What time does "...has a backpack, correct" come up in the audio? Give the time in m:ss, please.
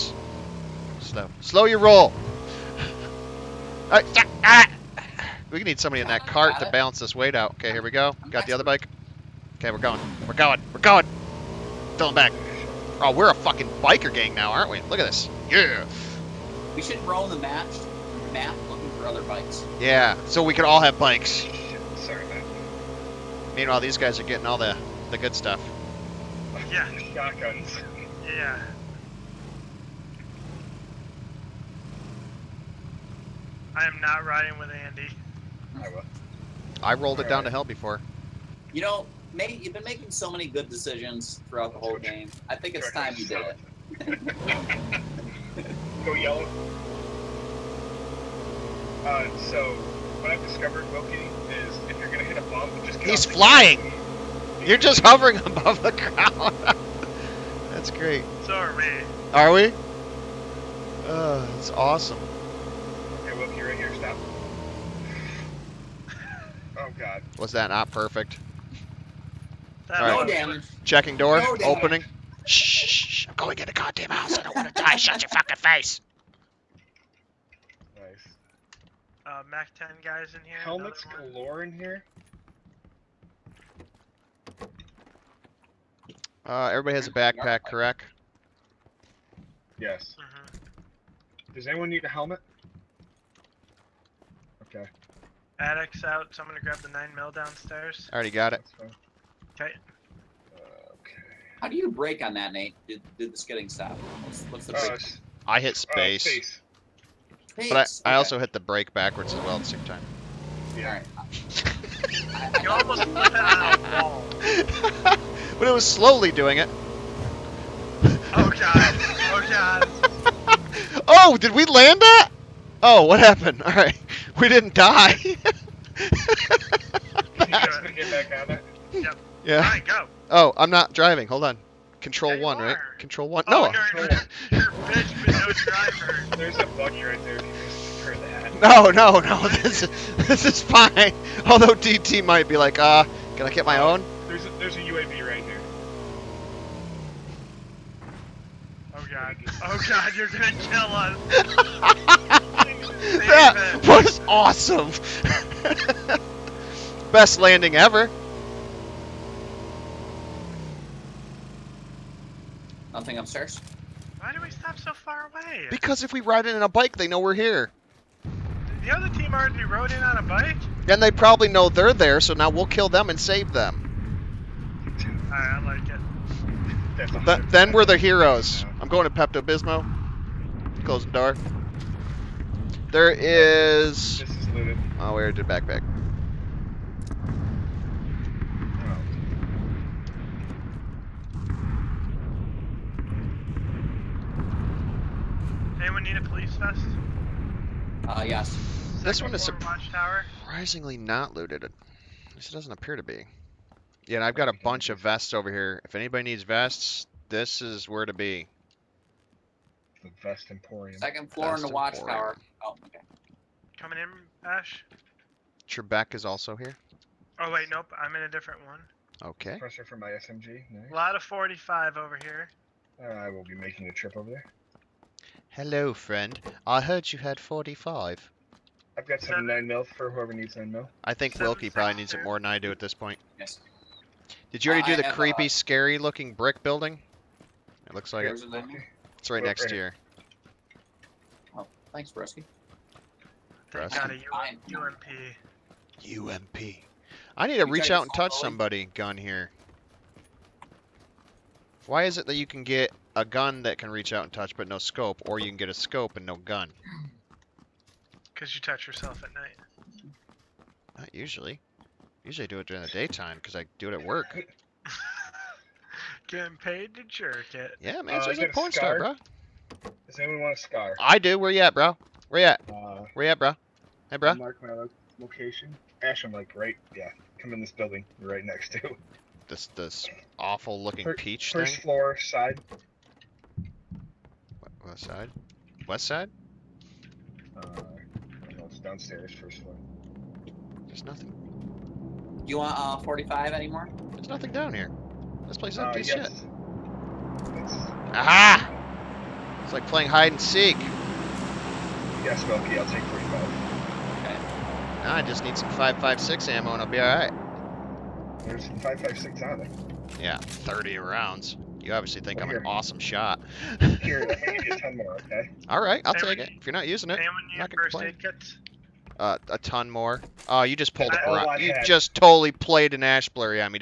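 1:26.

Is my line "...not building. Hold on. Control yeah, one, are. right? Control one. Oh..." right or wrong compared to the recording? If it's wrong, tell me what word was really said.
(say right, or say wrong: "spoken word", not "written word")
wrong: "driving", not "building".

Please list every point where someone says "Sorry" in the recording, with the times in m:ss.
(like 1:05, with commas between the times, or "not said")
0:21, 0:58.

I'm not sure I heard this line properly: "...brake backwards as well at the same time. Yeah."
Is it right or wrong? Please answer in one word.
right.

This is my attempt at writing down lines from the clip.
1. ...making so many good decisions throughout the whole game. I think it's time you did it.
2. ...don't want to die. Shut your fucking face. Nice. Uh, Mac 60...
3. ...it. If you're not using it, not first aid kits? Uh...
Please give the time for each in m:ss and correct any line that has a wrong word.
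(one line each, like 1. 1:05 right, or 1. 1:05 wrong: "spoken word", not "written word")
1. 0:39 right
2. 1:14 wrong: "10", not "60"
3. 5:16 right.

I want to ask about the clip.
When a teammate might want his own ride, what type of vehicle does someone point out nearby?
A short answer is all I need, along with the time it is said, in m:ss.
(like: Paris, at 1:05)
UAZ, at 2:24.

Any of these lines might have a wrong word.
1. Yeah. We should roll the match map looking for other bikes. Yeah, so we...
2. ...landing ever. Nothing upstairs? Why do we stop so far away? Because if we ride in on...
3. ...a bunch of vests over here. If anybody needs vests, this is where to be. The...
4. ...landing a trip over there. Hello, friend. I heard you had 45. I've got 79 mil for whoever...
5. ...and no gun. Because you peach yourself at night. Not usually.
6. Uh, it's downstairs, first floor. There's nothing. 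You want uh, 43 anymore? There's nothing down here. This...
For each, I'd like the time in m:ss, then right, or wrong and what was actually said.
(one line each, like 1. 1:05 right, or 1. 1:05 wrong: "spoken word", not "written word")
1. 0:15 right
2. 2:37 right
3. 3:24 right
4. 3:43 wrong: "making", not "landing"
5. 4:16 wrong: "touch", not "peach"
6. 4:47 wrong: "45", not "43".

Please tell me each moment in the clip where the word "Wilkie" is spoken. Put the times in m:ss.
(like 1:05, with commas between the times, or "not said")
0:50, 1:03, 3:51.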